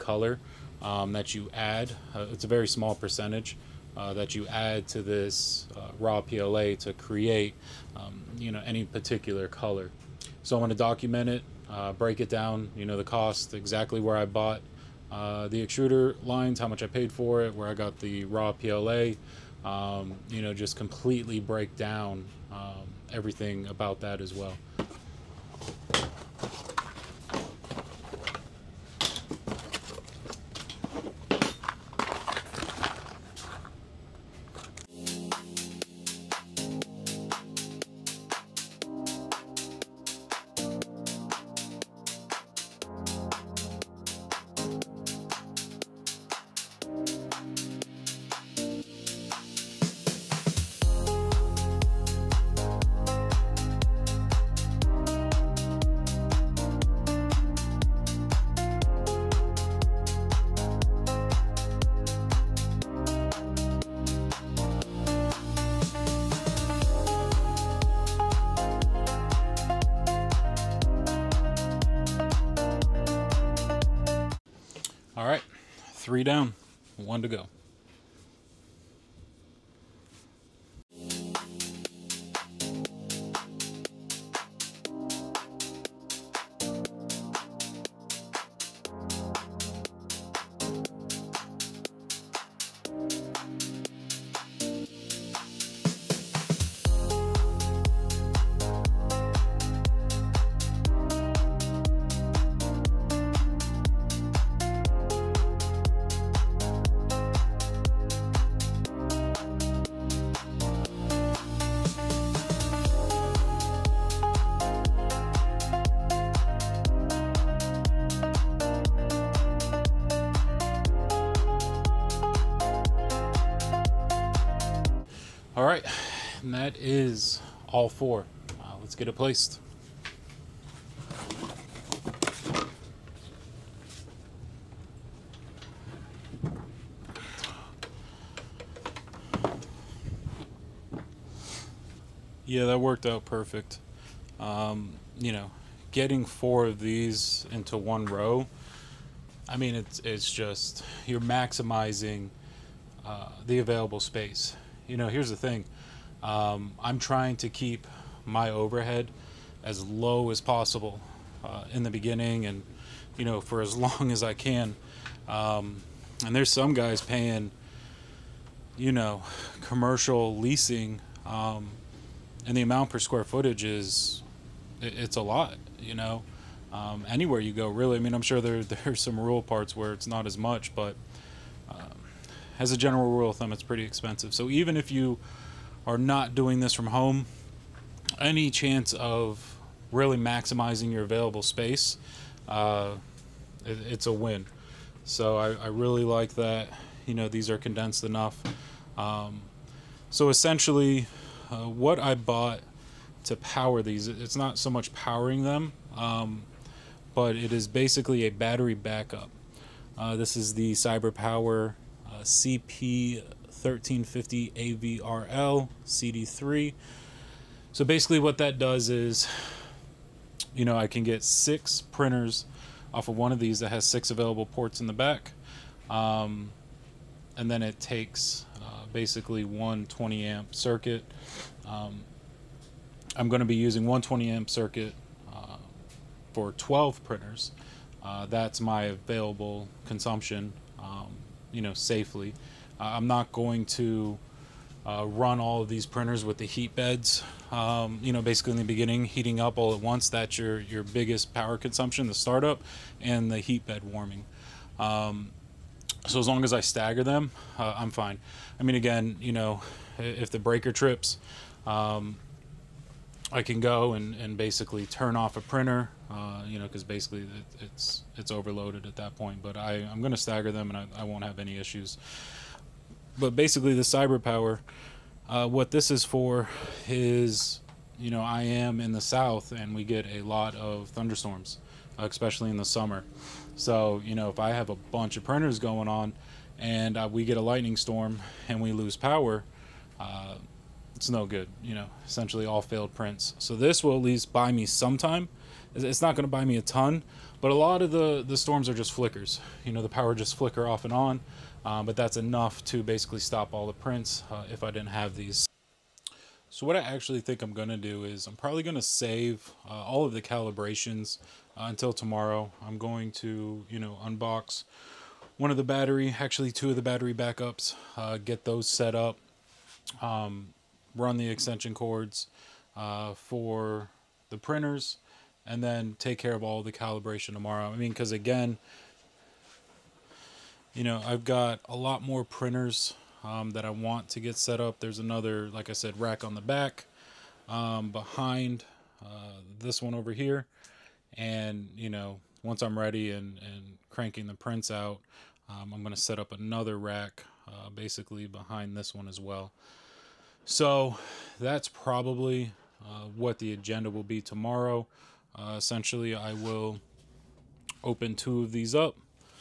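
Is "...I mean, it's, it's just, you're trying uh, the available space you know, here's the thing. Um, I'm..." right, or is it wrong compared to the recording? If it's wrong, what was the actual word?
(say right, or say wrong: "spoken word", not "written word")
wrong: "maximizing", not "trying".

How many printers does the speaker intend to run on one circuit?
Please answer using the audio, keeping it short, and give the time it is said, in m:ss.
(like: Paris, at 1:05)
12, at 3:56.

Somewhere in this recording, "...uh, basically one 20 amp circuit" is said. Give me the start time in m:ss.
3:48.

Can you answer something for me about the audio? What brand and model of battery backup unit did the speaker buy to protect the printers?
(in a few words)
CyberPower CP1350AVRLCD3.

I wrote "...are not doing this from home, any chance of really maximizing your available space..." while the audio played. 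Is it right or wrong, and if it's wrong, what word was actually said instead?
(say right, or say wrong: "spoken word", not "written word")
right.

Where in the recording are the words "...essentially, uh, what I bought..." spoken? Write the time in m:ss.
3:20.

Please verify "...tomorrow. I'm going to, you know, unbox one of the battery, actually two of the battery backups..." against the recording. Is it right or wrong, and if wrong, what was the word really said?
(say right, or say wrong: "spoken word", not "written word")
right.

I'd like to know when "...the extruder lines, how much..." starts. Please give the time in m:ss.
0:15.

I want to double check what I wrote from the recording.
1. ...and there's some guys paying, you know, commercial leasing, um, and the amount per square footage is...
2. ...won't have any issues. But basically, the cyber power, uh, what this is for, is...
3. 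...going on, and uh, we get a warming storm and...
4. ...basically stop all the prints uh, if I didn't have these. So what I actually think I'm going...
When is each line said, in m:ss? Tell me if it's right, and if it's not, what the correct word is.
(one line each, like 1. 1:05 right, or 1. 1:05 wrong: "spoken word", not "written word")
1. 2:46 right
2. 4:31 right
3. 4:45 wrong: "lightning", not "warming"
4. 5:02 right.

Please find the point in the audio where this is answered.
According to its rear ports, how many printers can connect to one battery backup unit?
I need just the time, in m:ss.
3:41.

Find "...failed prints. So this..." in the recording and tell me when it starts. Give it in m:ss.
4:52.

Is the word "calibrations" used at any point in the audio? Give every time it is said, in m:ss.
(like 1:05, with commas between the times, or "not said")
5:10, 5:26.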